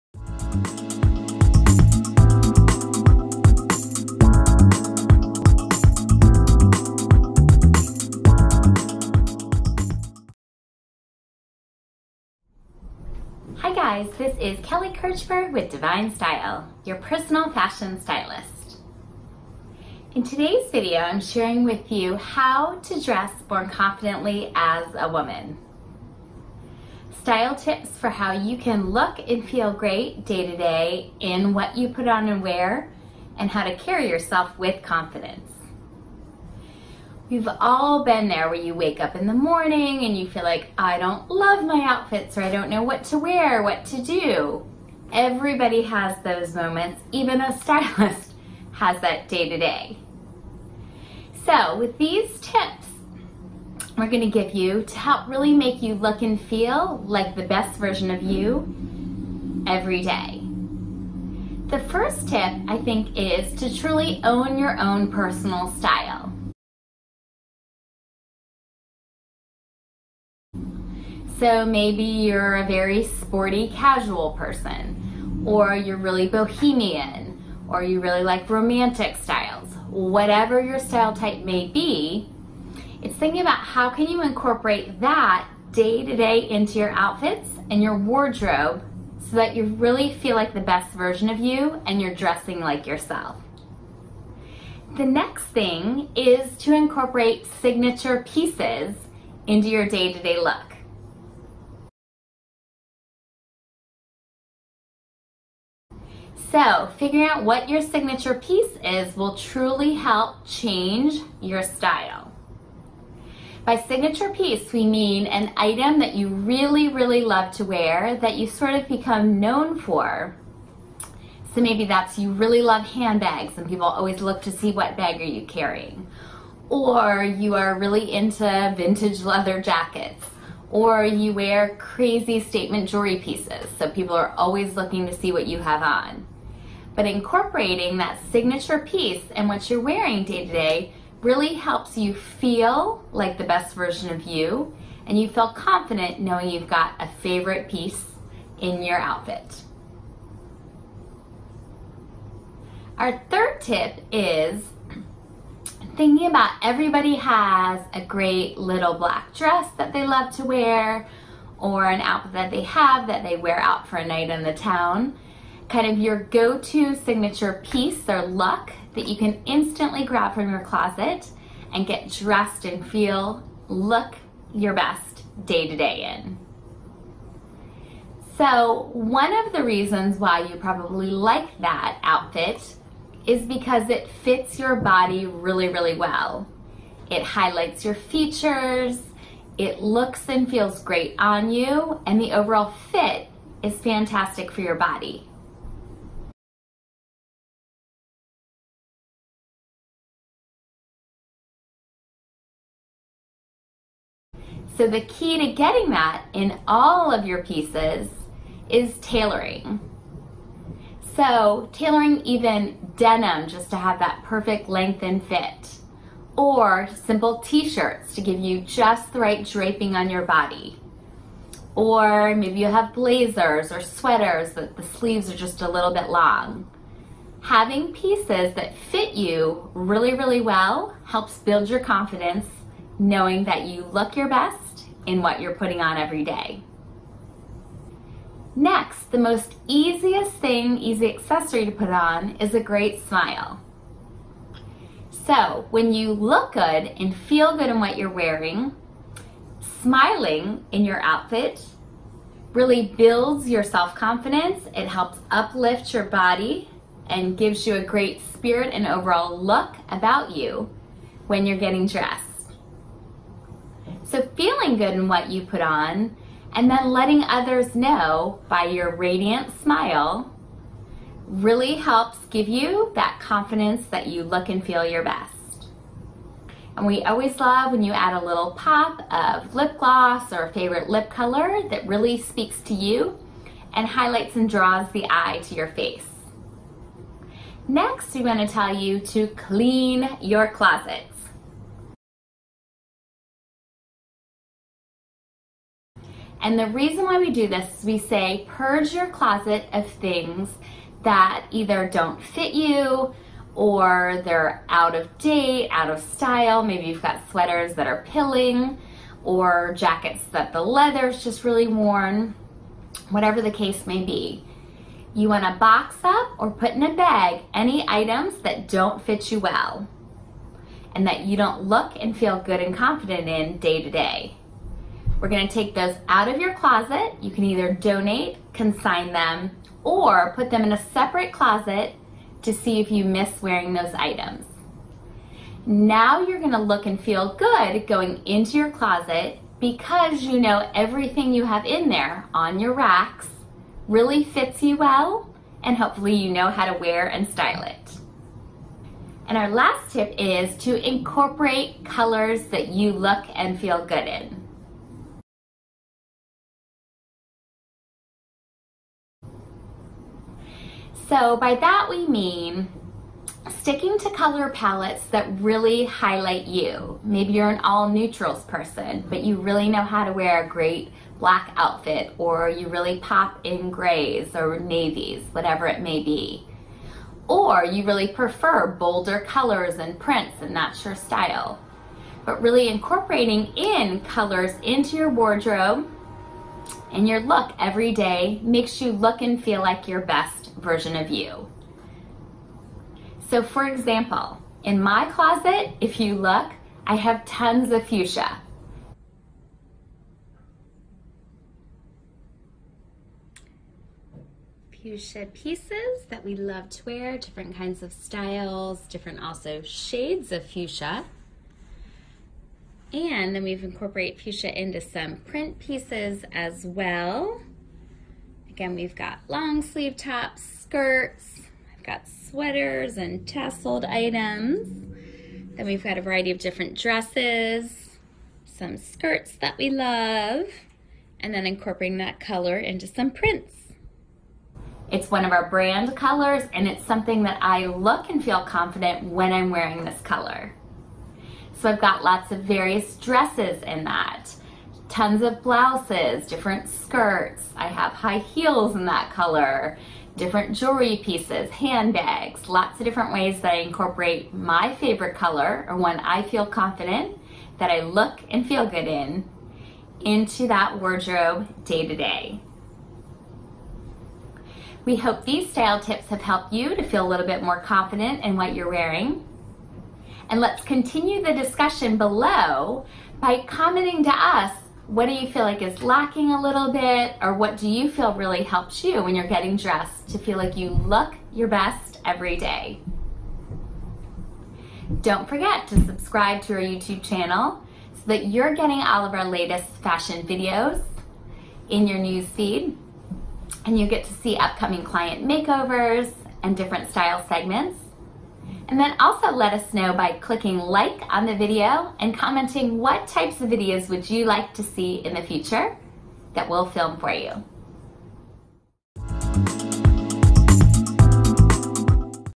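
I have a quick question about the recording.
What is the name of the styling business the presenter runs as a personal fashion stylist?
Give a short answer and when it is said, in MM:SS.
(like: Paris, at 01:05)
Divine Style, at 00:15.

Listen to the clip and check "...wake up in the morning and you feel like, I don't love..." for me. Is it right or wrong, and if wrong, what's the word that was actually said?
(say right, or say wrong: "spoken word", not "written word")
right.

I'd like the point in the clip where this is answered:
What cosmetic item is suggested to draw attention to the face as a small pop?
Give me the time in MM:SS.
04:39.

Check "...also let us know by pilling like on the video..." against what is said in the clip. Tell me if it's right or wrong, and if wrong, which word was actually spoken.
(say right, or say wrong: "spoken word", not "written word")
wrong: "clicking", not "pilling".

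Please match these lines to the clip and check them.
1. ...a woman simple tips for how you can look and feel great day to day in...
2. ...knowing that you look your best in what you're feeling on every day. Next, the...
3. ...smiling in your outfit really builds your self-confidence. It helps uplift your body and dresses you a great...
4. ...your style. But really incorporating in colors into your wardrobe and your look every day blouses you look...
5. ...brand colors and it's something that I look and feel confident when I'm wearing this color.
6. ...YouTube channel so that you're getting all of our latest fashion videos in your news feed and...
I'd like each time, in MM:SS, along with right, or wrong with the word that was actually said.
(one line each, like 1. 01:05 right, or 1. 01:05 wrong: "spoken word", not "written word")
1. 00:24 wrong: "style", not "simple"
2. 03:53 wrong: "putting", not "feeling"
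3. 04:09 wrong: "gives", not "dresses"
4. 06:20 wrong: "makes", not "blouses"
5. 07:15 right
6. 08:06 right.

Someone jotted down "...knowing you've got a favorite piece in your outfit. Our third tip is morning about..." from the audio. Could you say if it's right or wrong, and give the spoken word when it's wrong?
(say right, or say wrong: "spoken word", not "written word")
wrong: "thinking", not "morning".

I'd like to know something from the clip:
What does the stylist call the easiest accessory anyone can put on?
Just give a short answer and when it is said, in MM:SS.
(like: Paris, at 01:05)
A great smile, at 04:02.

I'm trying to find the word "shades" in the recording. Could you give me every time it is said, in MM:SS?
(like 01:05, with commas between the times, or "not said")
06:49.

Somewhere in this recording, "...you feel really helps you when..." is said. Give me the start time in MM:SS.
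07:57.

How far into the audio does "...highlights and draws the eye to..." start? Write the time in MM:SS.
04:43.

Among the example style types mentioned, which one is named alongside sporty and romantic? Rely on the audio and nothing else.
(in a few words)
Bohemian.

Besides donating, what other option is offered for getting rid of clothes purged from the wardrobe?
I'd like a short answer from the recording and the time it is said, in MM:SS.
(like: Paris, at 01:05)
Consign them, at 05:28.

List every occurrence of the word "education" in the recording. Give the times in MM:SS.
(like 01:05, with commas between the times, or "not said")
not said.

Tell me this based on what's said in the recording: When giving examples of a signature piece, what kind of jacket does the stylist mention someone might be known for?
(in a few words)
Vintage leather jackets.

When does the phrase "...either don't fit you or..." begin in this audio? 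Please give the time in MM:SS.
05:01.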